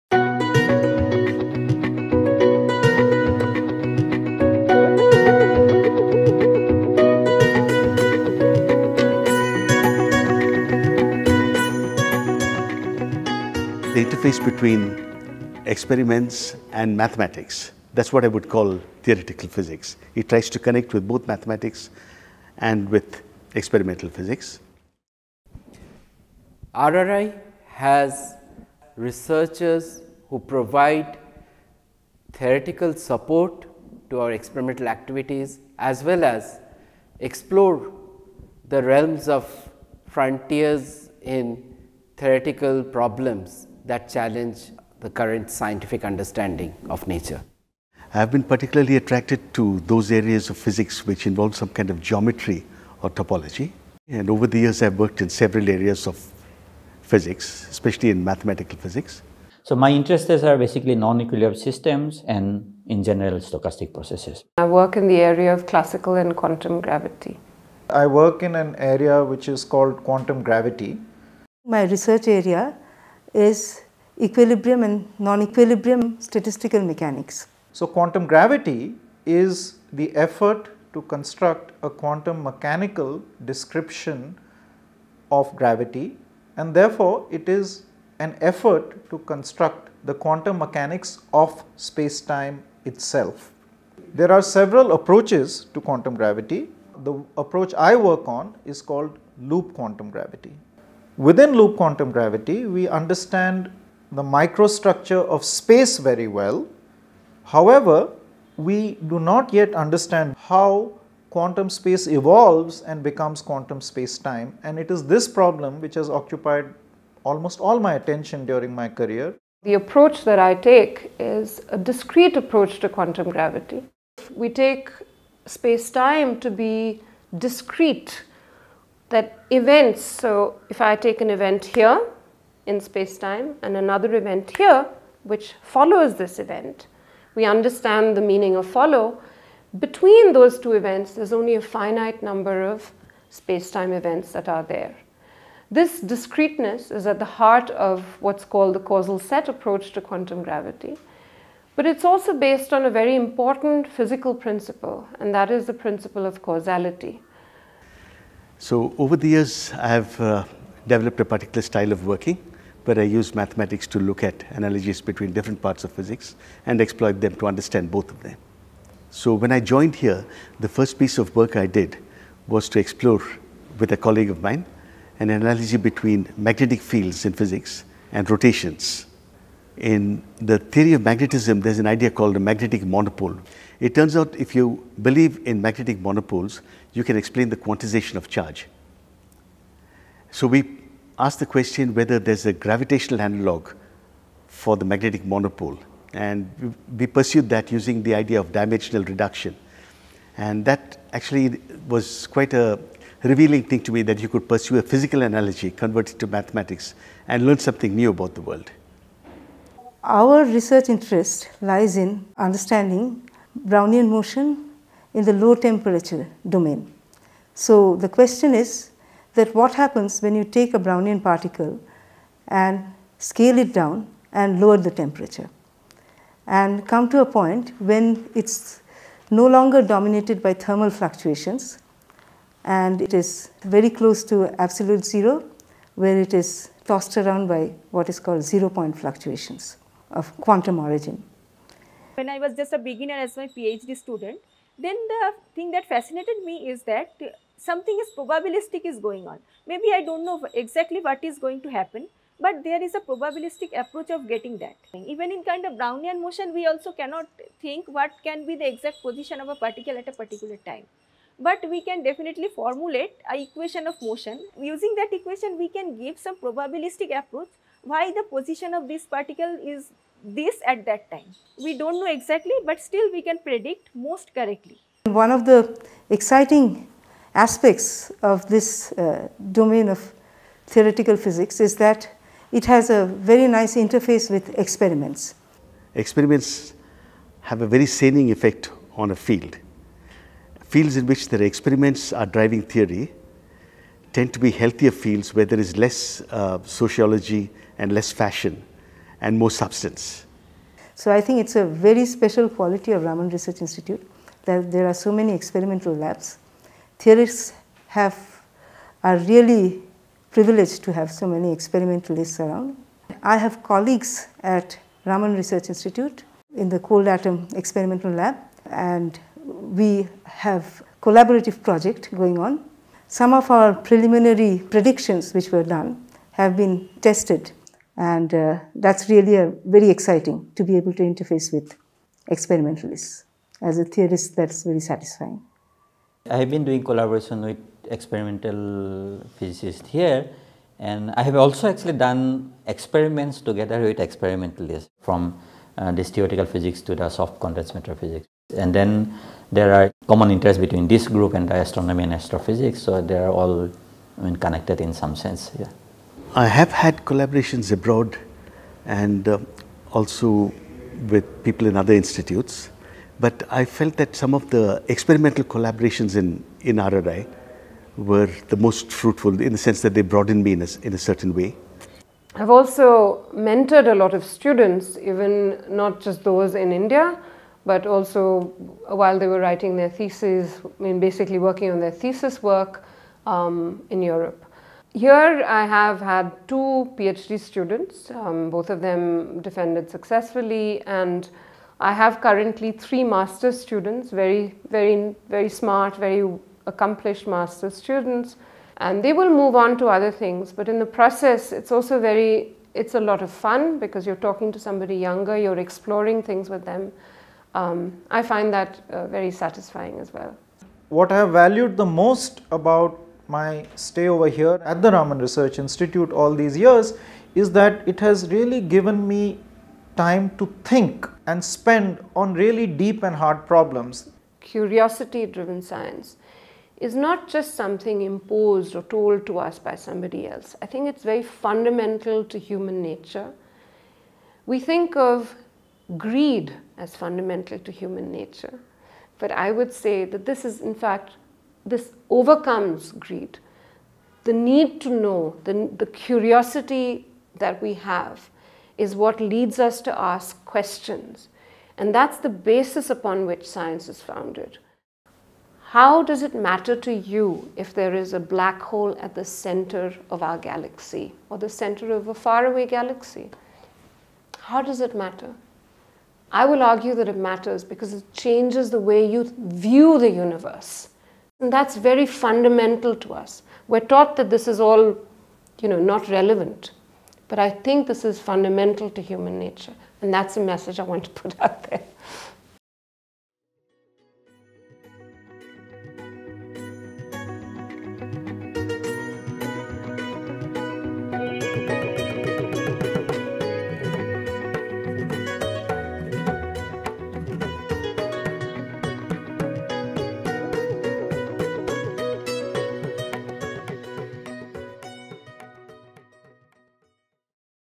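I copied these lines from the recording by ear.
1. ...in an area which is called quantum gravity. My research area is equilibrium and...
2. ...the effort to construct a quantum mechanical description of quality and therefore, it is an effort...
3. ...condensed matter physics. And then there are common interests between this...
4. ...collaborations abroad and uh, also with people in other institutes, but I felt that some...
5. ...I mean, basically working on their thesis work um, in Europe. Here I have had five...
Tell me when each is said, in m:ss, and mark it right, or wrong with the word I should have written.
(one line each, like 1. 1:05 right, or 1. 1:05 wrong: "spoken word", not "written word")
1. 1:08 right
2. 1:19 wrong: "gravity", not "quality"
3. 5:47 right
4. 5:57 right
5. 6:20 wrong: "two", not "five".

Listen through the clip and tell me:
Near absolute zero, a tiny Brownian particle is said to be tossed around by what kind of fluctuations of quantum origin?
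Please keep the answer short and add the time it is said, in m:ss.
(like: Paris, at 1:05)
Zero point fluctuations, at 3:58.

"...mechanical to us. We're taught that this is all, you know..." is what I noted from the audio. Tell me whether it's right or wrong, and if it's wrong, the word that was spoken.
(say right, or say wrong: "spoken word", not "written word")
wrong: "fundamental", not "mechanical".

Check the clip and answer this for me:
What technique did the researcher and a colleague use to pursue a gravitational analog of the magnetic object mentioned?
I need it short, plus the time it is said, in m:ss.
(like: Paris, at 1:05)
Dimensional reduction, at 3:18.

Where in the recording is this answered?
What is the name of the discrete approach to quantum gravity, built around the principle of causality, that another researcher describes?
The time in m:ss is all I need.
2:28.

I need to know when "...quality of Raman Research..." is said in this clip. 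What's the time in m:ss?
5:02.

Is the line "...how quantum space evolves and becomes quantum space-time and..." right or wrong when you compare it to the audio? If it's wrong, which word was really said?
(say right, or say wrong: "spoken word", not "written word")
right.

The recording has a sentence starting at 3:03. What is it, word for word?
It turns out if you believe in magnetic monopoles, you can explain the quantization of charge.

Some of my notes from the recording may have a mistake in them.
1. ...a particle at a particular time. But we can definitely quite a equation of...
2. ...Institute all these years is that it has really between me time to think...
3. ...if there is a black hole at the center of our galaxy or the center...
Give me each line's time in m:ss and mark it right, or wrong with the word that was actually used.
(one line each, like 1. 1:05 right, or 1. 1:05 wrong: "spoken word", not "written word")
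1. 4:19 wrong: "formulate", not "quite"
2. 6:55 wrong: "given", not "between"
3. 7:37 right.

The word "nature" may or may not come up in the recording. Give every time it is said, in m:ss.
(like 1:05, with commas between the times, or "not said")
0:47, 7:12, 7:18, 7:59.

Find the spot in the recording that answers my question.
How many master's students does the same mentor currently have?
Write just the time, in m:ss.
6:32.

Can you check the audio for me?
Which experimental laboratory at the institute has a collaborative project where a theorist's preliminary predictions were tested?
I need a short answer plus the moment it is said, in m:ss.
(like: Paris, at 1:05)
Cold Atom Experimental Lab, at 5:16.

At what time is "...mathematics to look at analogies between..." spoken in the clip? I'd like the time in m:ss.
2:43.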